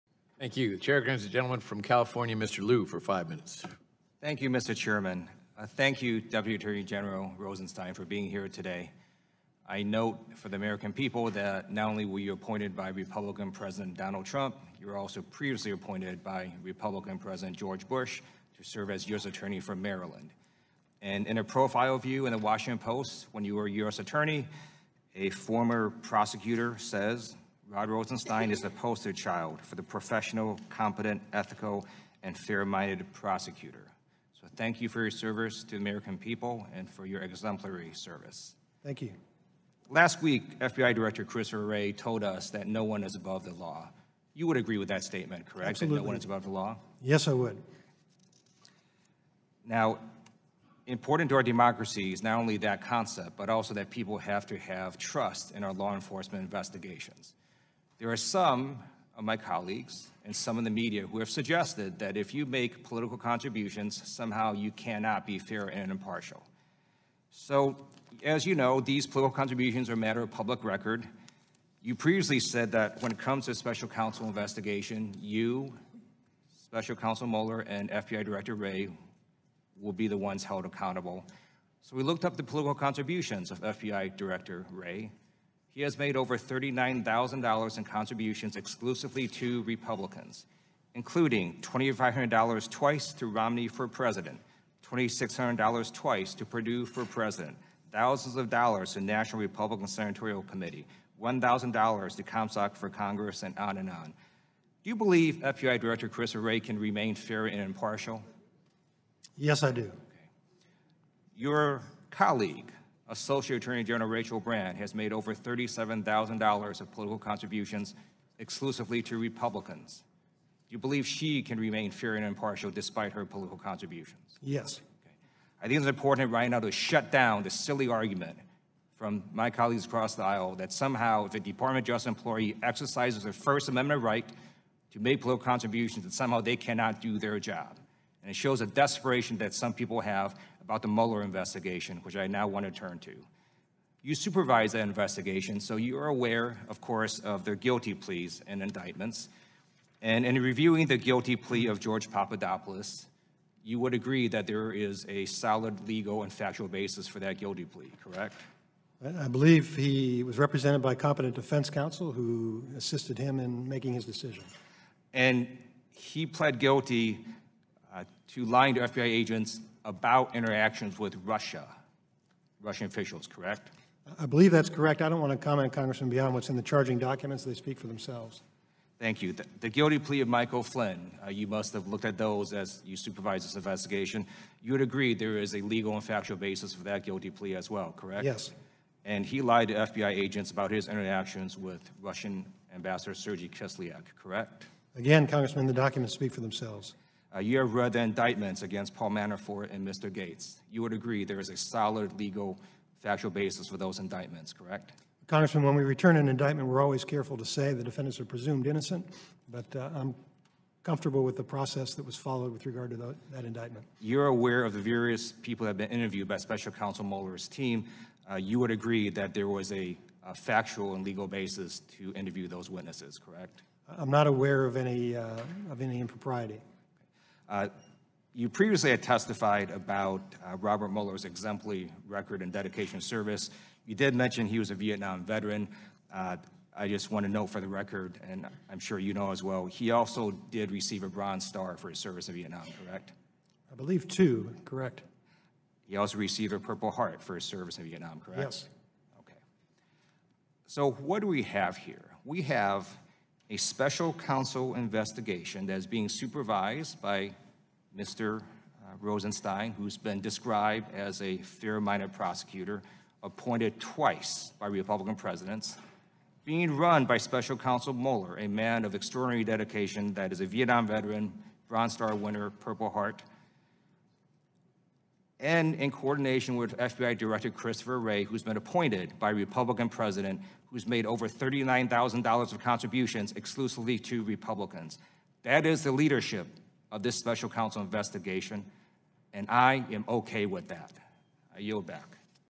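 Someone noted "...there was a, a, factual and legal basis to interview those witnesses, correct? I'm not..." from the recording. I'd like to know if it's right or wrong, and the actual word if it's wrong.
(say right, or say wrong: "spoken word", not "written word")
right.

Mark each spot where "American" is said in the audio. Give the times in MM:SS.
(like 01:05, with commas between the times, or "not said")
00:10, 00:35.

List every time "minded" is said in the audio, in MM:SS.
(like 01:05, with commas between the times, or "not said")
00:32, 04:21.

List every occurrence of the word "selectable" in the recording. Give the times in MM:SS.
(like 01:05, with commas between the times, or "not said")
not said.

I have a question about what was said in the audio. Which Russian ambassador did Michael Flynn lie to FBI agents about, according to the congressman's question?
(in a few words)
Sergei Kislyak.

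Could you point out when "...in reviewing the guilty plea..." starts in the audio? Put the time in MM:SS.
02:30.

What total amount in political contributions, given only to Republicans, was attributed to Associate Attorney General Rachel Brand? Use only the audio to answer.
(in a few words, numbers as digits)
$37,000.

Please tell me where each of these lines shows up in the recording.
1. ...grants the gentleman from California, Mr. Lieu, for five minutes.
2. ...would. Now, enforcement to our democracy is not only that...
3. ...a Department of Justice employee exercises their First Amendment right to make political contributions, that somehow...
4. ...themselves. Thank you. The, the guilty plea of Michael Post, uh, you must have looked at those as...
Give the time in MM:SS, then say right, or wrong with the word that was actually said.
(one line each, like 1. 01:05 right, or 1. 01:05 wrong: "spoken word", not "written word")
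1. 00:01 right
2. 00:47 wrong: "important", not "enforcement"
3. 02:11 right
4. 02:57 wrong: "Flynn", not "Post".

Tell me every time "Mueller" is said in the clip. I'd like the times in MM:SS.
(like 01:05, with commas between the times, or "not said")
01:17, 02:20, 03:37, 03:50, 04:27.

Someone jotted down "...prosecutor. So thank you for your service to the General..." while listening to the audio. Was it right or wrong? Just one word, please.
wrong.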